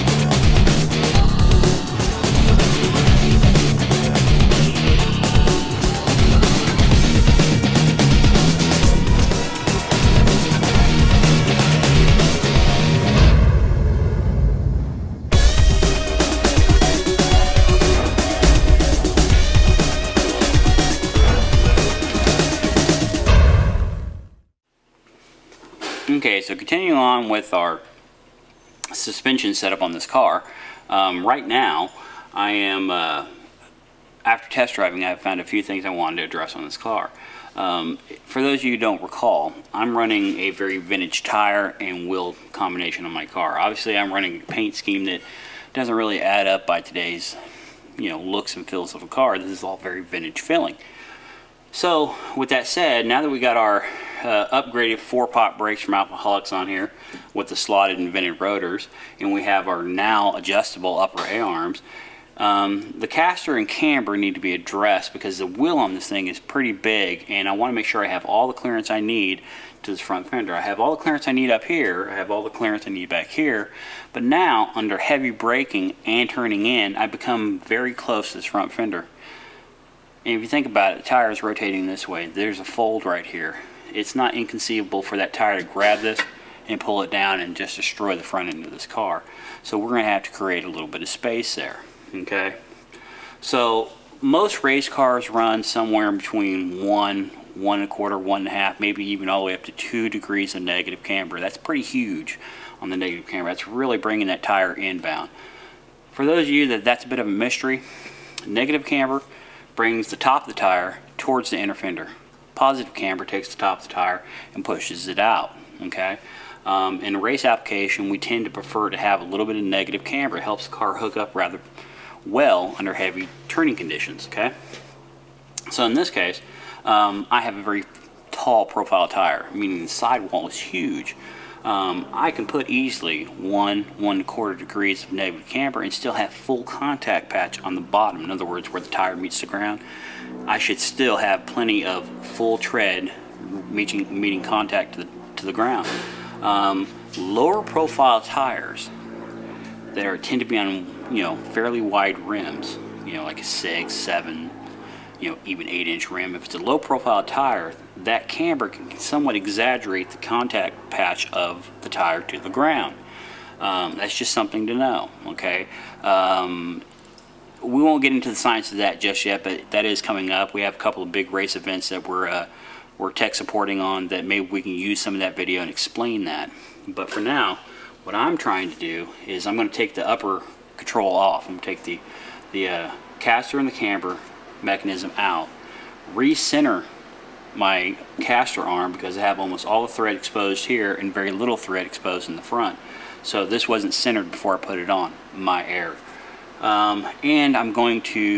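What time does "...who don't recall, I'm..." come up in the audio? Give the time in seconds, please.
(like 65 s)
38 s.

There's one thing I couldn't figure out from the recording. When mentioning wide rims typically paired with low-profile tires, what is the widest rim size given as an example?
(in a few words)
8-inch.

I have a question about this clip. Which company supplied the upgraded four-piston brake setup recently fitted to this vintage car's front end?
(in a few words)
Alfaholics.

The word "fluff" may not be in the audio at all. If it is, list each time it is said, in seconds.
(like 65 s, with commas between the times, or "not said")
not said.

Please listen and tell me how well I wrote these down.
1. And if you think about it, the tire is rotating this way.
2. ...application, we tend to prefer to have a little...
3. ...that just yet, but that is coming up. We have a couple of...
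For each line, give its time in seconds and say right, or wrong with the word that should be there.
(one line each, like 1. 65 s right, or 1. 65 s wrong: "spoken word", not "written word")
1. 80 s right
2. 117 s right
3. 168 s right.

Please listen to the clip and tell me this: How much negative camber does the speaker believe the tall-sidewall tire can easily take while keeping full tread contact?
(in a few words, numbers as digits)
1 1/4 degrees.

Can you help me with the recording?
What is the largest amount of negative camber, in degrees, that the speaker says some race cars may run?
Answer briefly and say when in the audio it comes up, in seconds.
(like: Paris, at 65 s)
2 degrees, at 99 s.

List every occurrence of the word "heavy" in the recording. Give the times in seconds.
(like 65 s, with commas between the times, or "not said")
74 s, 122 s.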